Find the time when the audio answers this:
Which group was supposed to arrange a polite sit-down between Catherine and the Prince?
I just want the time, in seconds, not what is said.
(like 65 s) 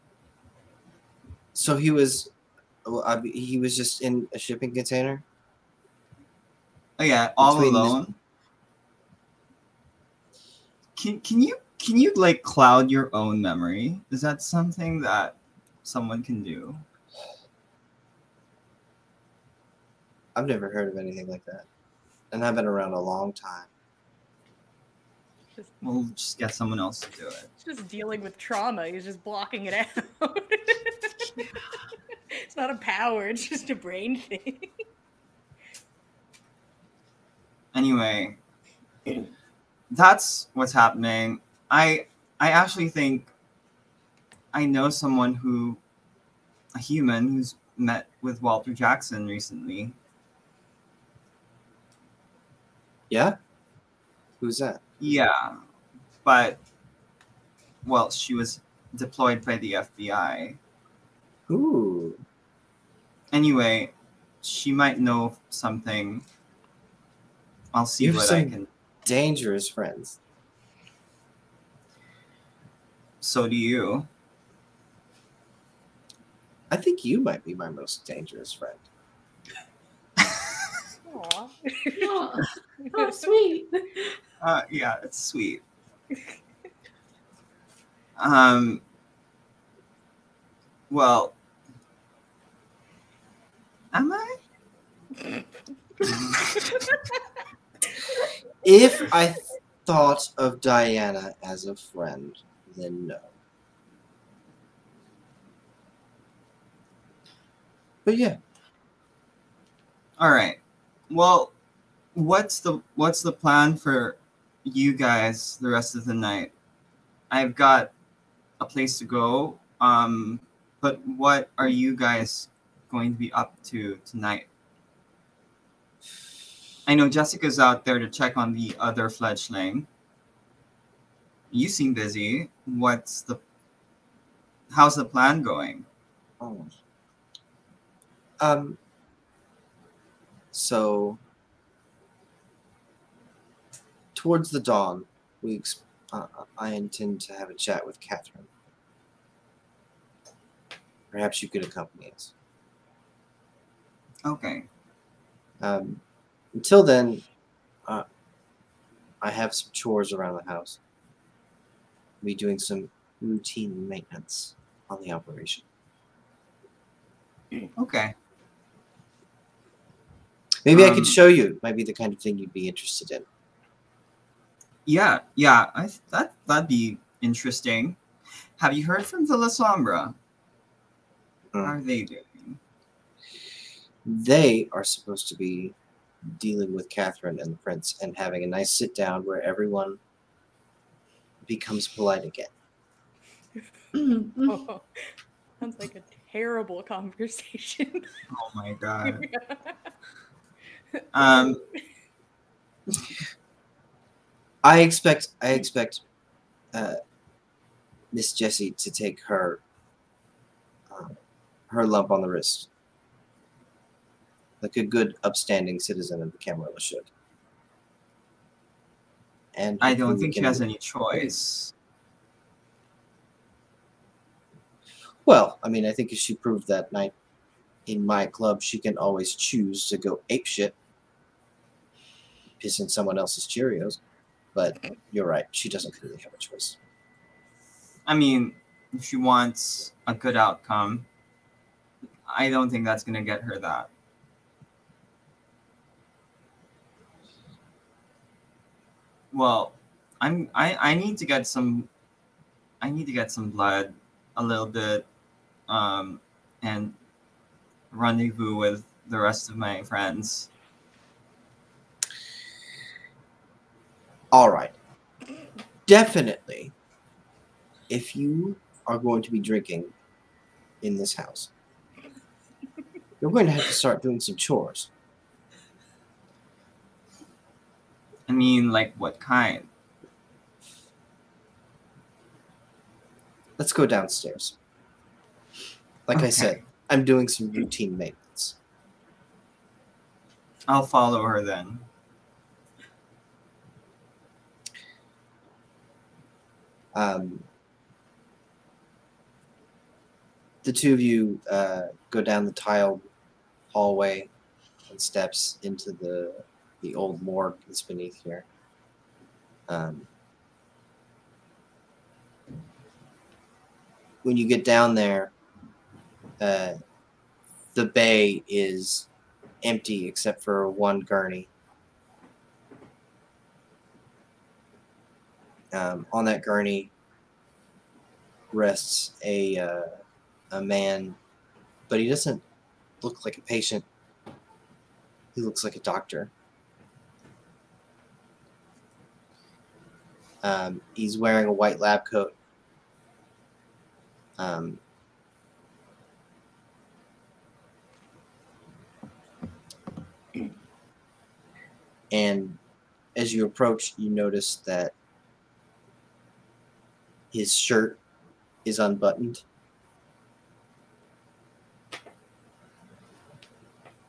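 179 s.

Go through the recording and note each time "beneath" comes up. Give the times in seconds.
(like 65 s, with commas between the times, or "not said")
307 s.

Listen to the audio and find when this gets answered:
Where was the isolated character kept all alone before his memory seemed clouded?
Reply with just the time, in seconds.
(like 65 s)
4 s.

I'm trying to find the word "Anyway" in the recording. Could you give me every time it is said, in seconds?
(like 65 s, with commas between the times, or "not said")
37 s, 63 s.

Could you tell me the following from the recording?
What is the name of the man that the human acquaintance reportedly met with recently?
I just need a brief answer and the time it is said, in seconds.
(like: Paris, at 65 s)
Walter Jackson, at 48 s.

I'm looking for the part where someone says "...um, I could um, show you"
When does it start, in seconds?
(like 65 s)
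170 s.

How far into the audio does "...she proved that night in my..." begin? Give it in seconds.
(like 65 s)
226 s.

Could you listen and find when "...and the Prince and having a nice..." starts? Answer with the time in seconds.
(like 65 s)
187 s.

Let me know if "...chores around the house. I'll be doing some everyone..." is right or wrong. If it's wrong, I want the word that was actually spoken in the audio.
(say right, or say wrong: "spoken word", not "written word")
wrong: "routine", not "everyone".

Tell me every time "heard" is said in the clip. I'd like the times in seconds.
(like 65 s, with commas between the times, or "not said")
20 s, 178 s.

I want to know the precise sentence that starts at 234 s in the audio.
But you're right; she doesn't really have a choice.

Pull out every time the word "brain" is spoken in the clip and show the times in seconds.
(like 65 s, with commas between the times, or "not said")
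33 s.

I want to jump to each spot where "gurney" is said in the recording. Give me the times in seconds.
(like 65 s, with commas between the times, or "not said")
321 s, 326 s.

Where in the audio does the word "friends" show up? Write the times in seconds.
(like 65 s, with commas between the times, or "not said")
69 s, 78 s, 101 s, 259 s.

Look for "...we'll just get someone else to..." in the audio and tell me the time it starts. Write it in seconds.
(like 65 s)
25 s.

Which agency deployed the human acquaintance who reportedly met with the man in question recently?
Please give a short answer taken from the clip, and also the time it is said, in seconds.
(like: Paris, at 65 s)
FBI, at 59 s.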